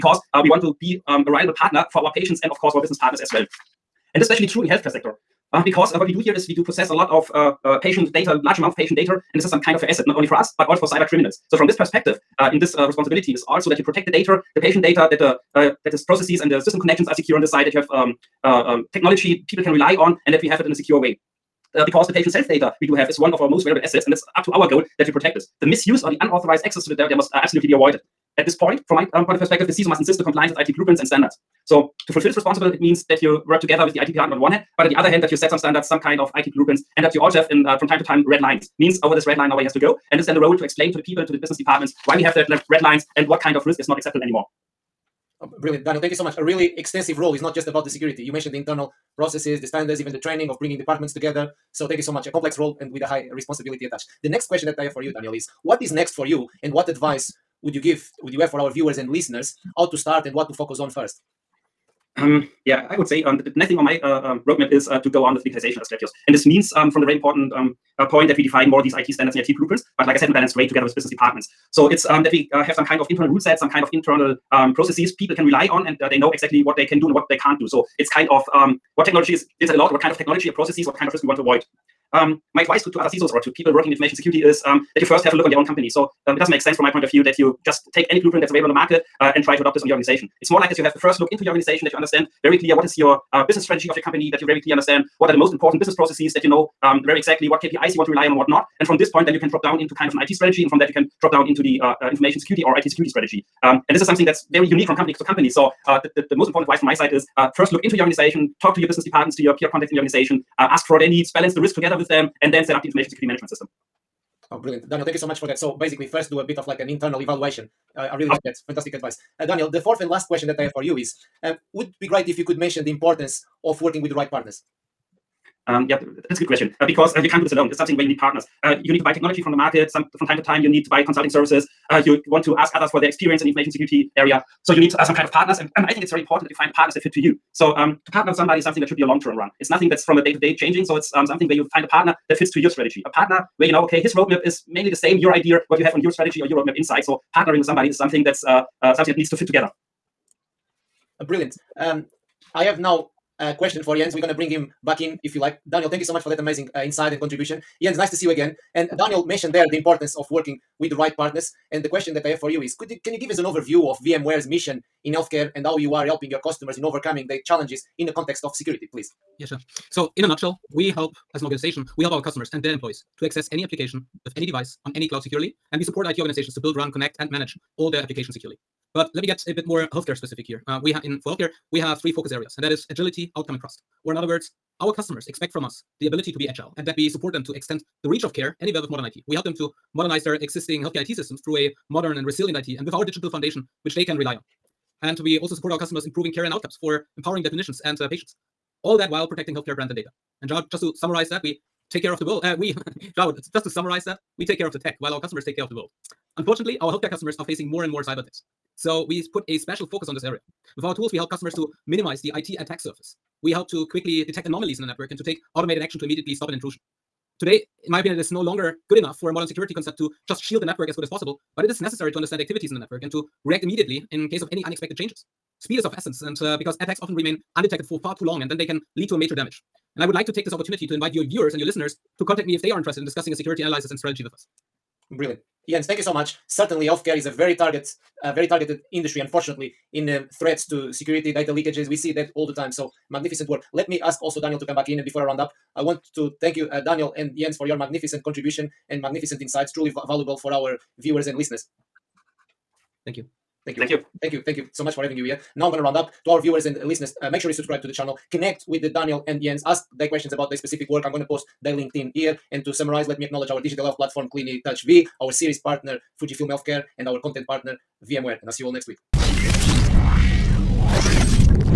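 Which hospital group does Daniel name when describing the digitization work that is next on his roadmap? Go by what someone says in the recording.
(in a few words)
Asklepios.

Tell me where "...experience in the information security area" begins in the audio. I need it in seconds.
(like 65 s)
133 s.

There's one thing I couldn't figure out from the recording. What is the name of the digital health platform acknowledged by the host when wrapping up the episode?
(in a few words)
Clinitouch Vie.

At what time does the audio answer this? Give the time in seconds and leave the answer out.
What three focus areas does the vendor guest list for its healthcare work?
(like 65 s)
182 s.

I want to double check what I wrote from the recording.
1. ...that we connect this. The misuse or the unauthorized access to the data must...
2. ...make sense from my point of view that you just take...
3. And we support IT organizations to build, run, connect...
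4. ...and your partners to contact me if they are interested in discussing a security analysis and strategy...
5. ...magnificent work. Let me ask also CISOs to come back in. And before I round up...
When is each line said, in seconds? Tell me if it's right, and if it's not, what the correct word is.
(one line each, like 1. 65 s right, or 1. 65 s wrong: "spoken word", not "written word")
1. 24 s wrong: "protect", not "connect"
2. 86 s right
3. 175 s right
4. 231 s wrong: "listeners", not "partners"
5. 243 s wrong: "Daniel", not "CISOs".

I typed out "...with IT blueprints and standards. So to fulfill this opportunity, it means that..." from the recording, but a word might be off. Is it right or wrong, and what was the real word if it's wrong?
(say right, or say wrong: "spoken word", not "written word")
wrong: "responsibility", not "opportunity".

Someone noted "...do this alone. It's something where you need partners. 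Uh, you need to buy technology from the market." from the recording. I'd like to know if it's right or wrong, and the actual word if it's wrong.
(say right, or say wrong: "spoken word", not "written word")
right.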